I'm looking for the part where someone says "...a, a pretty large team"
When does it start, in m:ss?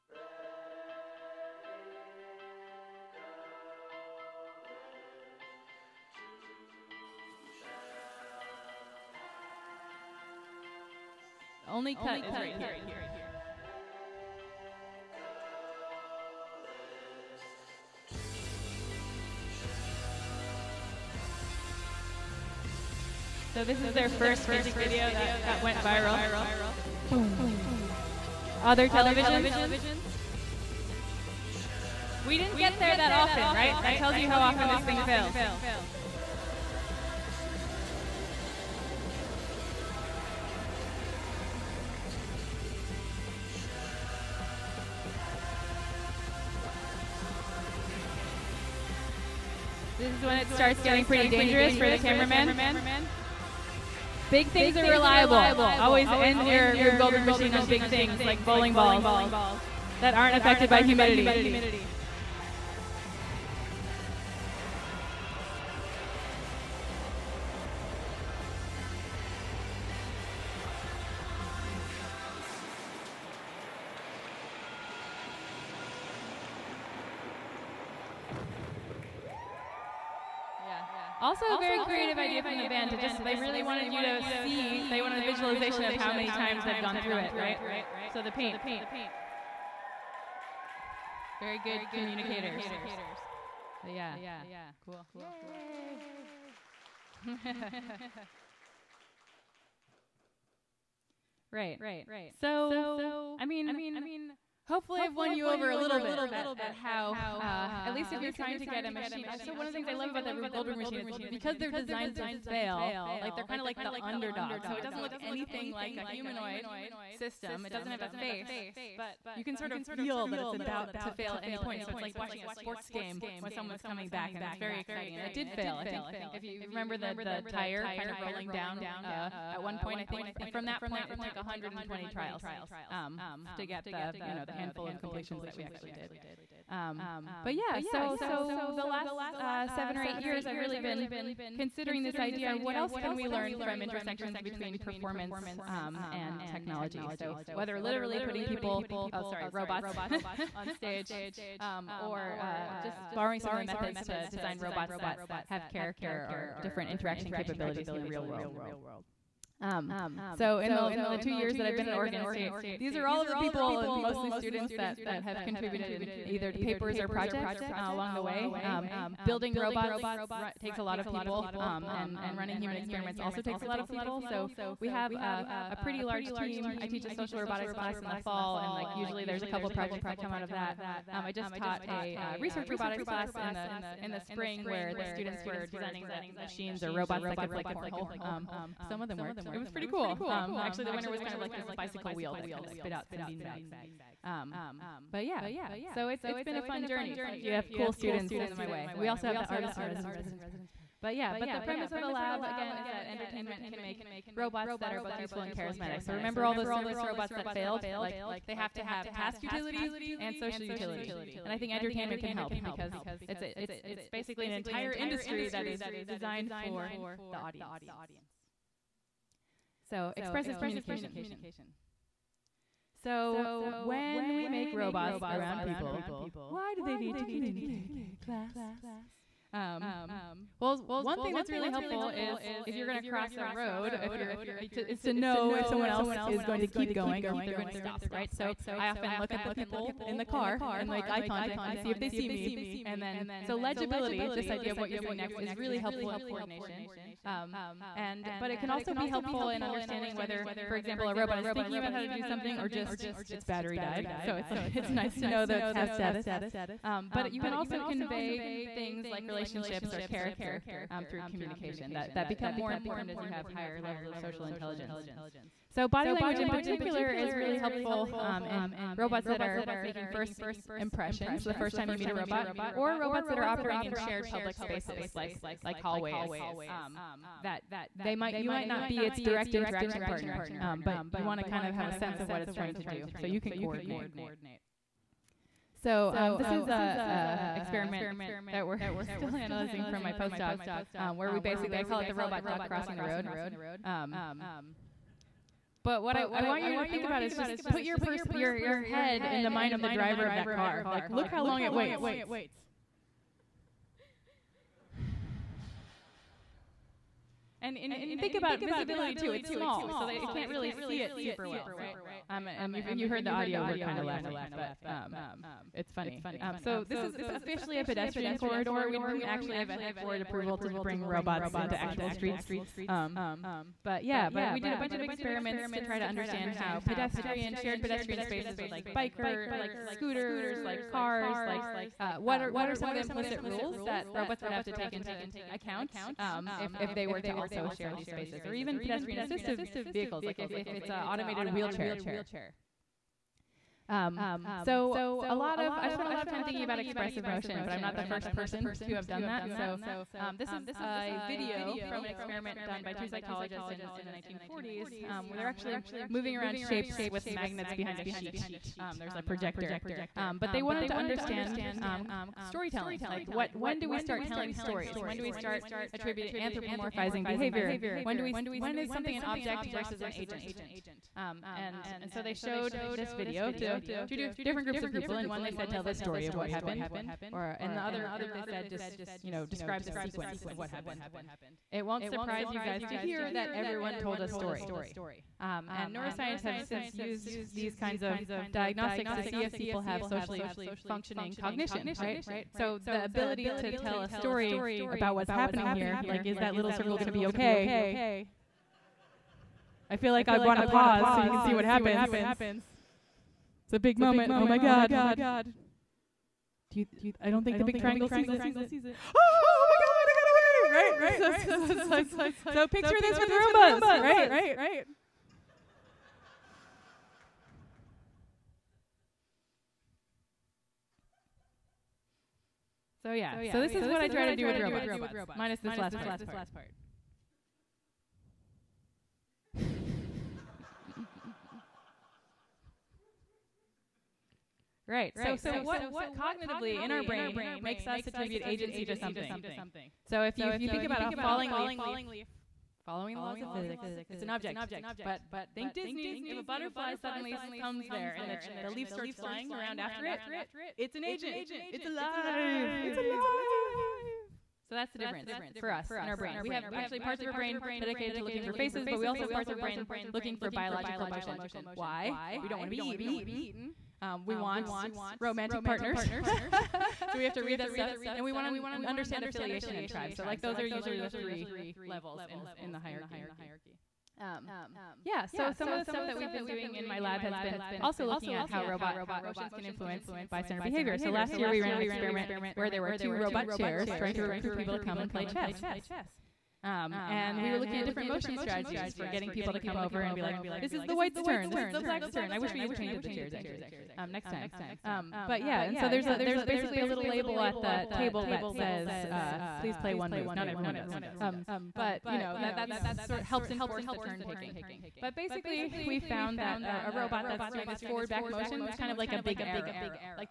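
2:55.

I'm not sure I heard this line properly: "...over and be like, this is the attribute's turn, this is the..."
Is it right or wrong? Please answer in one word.
wrong.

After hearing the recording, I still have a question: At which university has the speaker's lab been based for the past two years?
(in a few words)
Oregon State.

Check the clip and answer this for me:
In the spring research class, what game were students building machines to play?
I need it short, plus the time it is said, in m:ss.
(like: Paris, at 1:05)
cornhole, at 3:07.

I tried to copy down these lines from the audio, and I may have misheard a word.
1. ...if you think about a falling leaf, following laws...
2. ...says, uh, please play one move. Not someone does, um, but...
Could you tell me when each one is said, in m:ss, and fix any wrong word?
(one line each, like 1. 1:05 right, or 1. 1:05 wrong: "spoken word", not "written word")
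1. 7:20 right
2. 8:18 wrong: "everyone", not "someone".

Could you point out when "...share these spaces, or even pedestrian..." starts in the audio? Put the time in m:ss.
5:37.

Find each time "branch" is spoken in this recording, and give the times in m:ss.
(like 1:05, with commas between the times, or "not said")
not said.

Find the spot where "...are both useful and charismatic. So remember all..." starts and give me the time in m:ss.
3:24.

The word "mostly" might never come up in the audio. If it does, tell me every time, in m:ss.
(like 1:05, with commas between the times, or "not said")
2:44.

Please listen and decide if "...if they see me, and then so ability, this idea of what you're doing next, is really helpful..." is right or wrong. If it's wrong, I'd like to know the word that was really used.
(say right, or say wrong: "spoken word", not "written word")
wrong: "legibility", not "ability".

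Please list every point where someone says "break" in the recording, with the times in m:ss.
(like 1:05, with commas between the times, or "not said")
not said.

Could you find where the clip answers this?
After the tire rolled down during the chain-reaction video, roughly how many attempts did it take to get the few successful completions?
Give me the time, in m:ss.
2:11.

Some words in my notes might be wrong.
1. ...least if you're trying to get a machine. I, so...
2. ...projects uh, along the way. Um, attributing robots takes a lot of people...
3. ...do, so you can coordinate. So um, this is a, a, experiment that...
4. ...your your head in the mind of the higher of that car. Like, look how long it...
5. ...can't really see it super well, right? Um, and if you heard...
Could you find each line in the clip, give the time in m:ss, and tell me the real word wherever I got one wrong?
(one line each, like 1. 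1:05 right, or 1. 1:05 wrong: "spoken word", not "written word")
1. 1:47 right
2. 2:47 wrong: "building", not "attributing"
3. 4:42 right
4. 4:58 wrong: "driver", not "higher"
5. 5:10 right.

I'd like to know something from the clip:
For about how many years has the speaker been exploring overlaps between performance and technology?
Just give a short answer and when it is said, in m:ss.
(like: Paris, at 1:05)
seven or eight, at 2:19.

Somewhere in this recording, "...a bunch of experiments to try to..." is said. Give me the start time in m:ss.
5:24.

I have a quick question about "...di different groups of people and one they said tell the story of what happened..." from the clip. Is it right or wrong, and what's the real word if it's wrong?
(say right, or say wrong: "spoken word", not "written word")
right.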